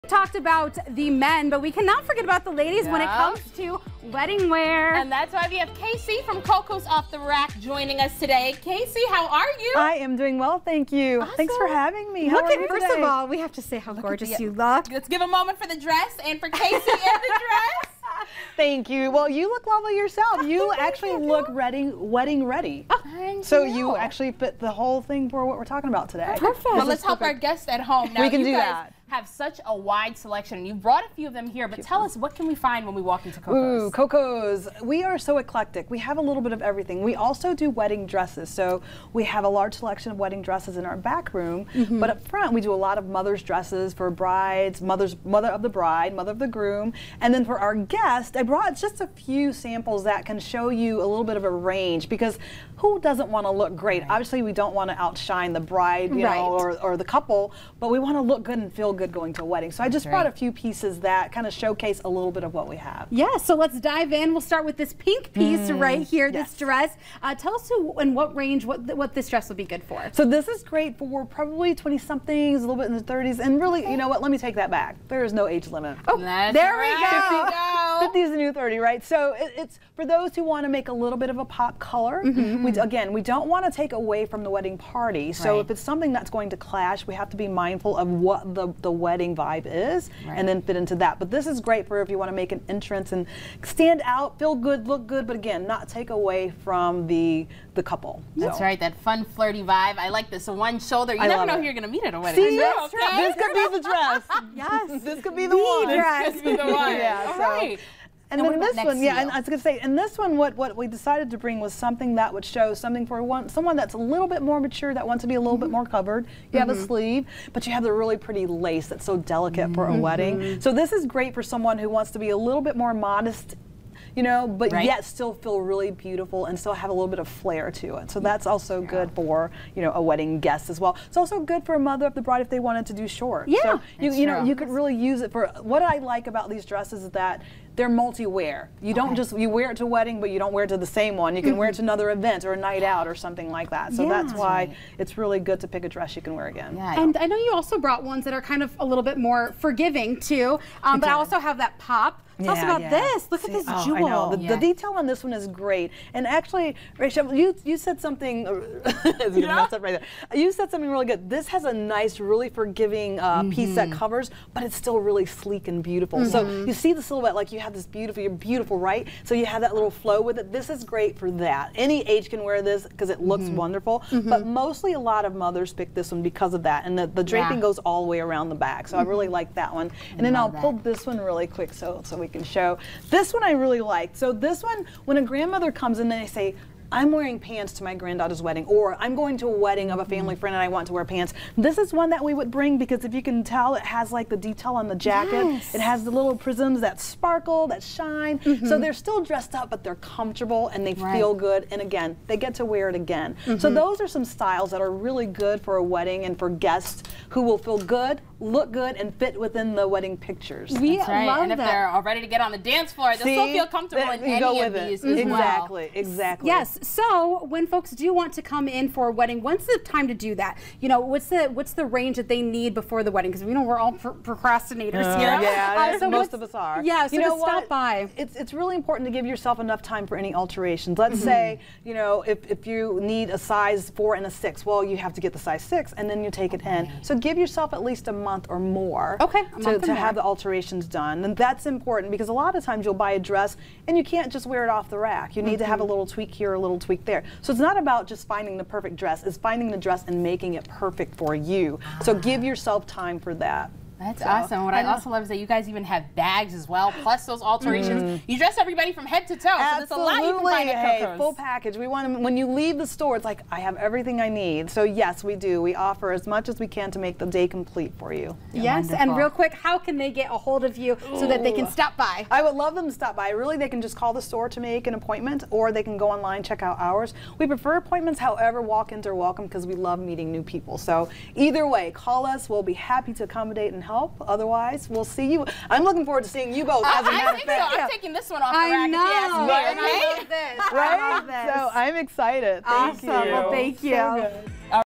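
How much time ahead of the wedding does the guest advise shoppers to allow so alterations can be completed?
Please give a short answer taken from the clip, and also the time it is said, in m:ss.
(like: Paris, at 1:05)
a month, at 3:58.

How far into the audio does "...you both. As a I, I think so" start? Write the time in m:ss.
4:46.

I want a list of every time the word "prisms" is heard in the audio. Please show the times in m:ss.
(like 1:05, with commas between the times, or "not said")
3:16.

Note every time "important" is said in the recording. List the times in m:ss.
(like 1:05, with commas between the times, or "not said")
3:48, 4:01.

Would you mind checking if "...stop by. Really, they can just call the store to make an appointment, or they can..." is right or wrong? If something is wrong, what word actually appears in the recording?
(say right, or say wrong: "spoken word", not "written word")
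right.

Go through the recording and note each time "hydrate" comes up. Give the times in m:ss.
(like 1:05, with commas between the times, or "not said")
not said.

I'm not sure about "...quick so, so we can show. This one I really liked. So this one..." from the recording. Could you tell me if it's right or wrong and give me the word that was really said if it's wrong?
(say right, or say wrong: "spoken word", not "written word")
right.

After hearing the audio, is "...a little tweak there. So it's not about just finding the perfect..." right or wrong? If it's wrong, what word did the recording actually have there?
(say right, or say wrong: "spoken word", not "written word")
right.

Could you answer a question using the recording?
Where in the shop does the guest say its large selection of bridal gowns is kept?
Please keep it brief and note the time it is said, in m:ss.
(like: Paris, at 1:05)
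back room, at 0:40.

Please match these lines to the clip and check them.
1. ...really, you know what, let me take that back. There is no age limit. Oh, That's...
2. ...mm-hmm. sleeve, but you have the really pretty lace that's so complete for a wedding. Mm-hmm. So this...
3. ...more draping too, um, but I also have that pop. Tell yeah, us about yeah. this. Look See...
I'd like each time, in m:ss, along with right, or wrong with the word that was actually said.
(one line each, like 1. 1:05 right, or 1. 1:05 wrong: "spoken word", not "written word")
1. 1:13 right
2. 1:56 wrong: "delicate", not "complete"
3. 2:29 wrong: "forgiving", not "draping".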